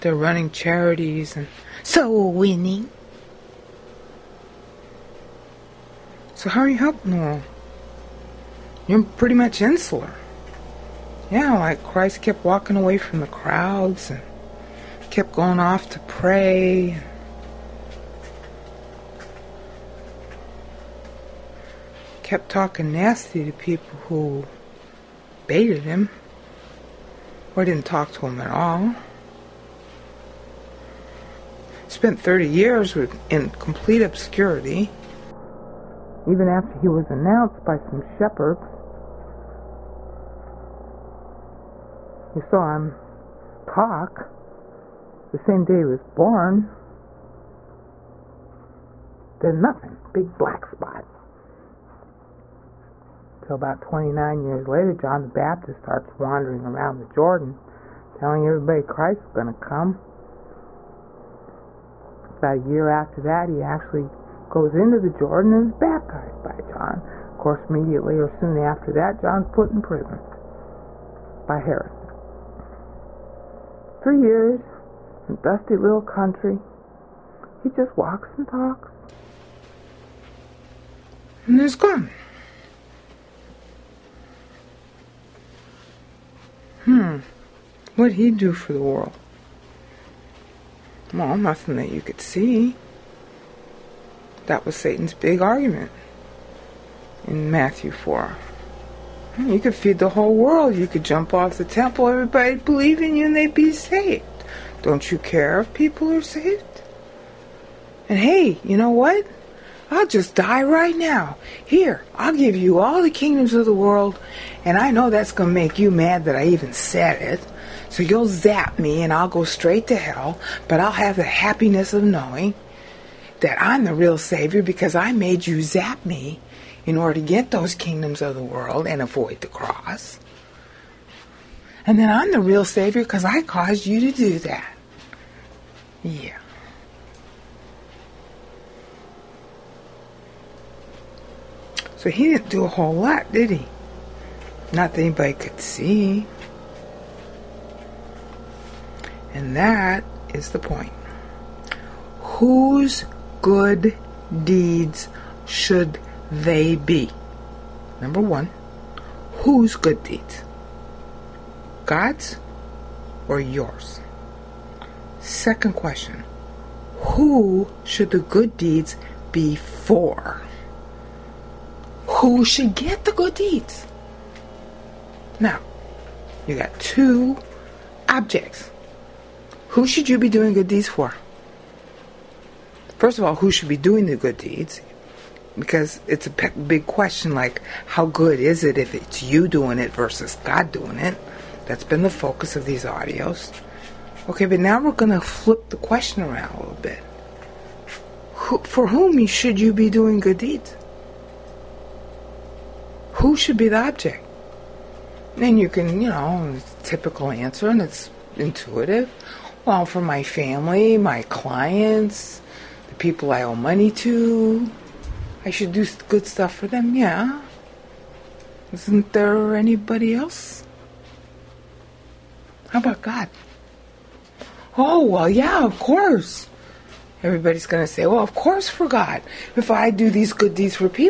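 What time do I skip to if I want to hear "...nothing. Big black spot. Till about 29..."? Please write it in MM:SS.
00:49.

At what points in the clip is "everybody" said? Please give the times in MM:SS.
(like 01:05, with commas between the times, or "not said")
00:58, 01:42, 03:47.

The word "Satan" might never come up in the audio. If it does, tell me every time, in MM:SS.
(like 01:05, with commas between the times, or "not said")
01:34.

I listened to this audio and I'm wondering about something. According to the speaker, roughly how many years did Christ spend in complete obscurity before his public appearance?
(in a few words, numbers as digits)
30.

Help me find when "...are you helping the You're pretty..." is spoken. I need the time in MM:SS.
00:06.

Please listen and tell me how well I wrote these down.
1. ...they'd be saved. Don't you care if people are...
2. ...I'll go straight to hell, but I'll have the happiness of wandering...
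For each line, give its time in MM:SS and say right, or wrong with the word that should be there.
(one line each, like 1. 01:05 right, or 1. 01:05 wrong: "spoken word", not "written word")
1. 01:43 right
2. 01:59 wrong: "knowing", not "wandering".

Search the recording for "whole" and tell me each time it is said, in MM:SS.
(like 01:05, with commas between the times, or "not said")
01:40, 02:22.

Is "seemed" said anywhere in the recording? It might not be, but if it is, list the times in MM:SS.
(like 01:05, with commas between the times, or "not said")
not said.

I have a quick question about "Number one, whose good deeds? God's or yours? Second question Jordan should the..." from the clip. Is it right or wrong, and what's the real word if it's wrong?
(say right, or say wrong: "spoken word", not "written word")
wrong: "Who", not "Jordan".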